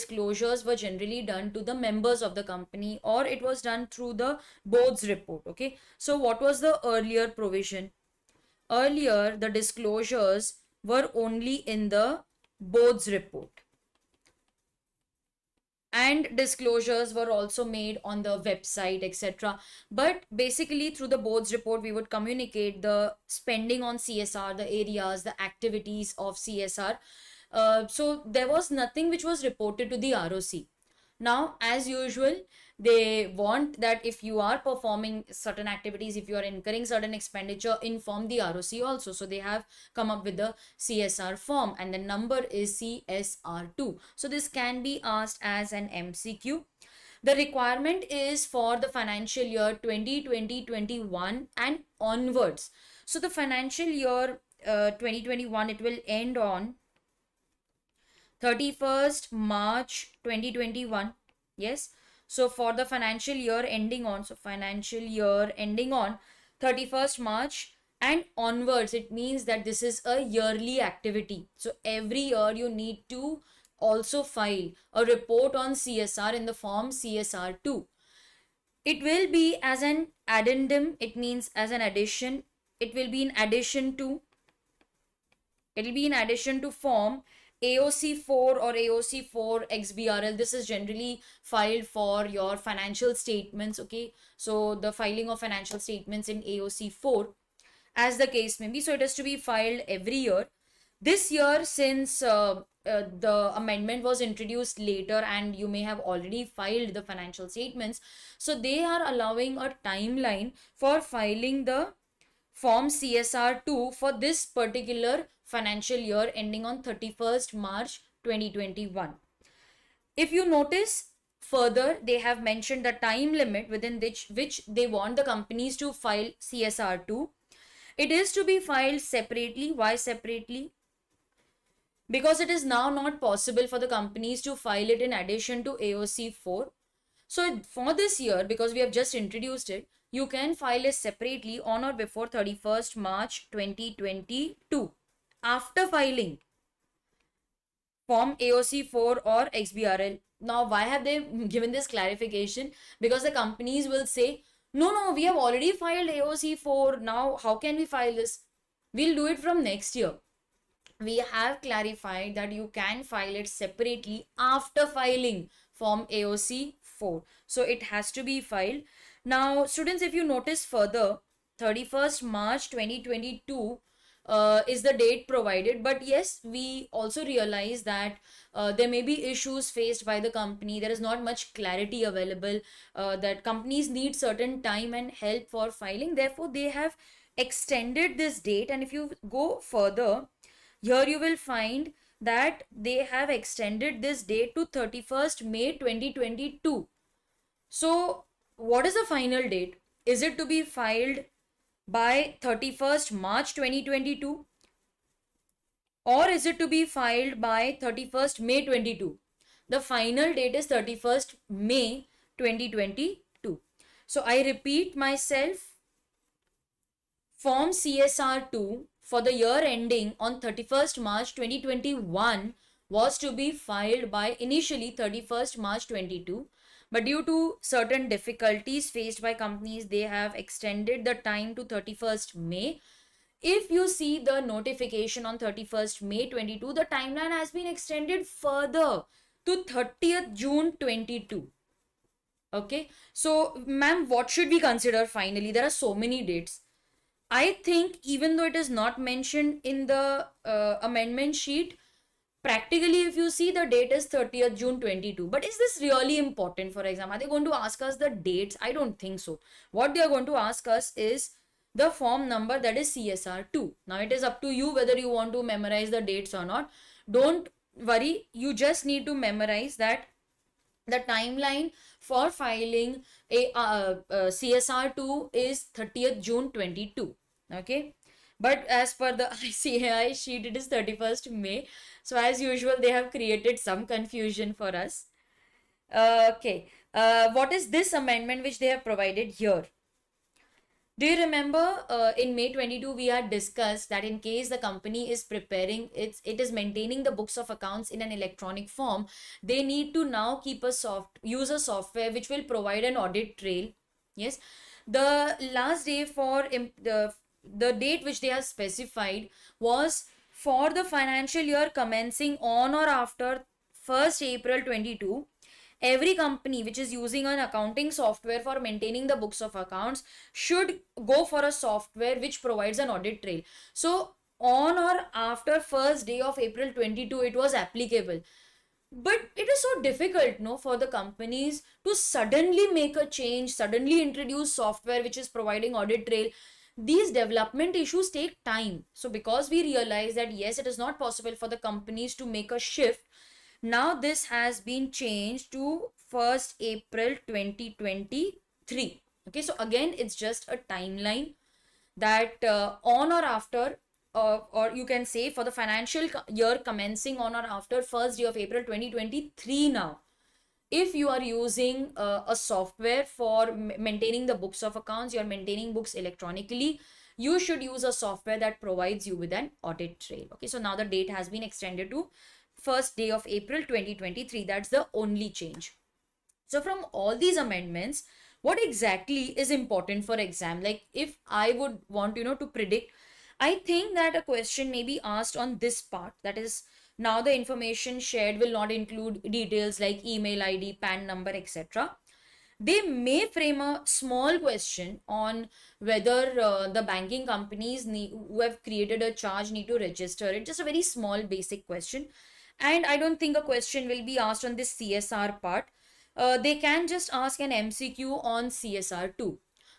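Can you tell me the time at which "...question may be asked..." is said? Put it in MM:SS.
06:24.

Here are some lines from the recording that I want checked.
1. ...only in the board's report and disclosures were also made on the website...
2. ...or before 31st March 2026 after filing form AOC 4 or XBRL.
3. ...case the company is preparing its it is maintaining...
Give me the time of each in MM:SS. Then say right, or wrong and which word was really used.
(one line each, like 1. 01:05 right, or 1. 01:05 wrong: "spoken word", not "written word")
1. 00:11 right
2. 02:21 wrong: "2022", not "2026"
3. 04:54 right.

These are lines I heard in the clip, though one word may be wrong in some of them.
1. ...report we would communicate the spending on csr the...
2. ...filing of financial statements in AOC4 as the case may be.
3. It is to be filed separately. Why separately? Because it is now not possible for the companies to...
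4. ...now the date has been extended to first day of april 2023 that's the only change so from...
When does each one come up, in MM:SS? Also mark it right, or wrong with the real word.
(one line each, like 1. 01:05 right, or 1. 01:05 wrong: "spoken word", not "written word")
1. 00:21 right
2. 01:34 right
3. 02:07 right
4. 06:10 right.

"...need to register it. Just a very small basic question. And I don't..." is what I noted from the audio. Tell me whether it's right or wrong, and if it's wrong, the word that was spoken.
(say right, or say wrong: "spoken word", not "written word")
right.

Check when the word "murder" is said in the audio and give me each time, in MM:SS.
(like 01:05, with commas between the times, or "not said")
not said.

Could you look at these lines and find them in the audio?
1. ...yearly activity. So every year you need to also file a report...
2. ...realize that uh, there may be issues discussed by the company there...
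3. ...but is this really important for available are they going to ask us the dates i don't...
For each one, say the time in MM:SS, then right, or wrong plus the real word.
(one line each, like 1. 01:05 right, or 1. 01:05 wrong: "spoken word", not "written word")
1. 01:10 right
2. 02:57 wrong: "faced", not "discussed"
3. 04:15 wrong: "example", not "available".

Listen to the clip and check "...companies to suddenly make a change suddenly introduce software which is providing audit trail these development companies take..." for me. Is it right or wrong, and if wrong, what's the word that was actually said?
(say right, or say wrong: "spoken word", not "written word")
wrong: "issues", not "companies".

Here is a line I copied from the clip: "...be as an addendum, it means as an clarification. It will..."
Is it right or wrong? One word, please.
wrong.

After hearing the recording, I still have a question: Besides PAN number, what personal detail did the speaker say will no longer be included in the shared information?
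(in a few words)
Email ID.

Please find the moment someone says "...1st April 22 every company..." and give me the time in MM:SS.
05:13.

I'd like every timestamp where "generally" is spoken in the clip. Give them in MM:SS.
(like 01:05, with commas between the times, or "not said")
00:00, 01:30.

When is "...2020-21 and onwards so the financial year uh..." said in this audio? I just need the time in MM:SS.
00:49.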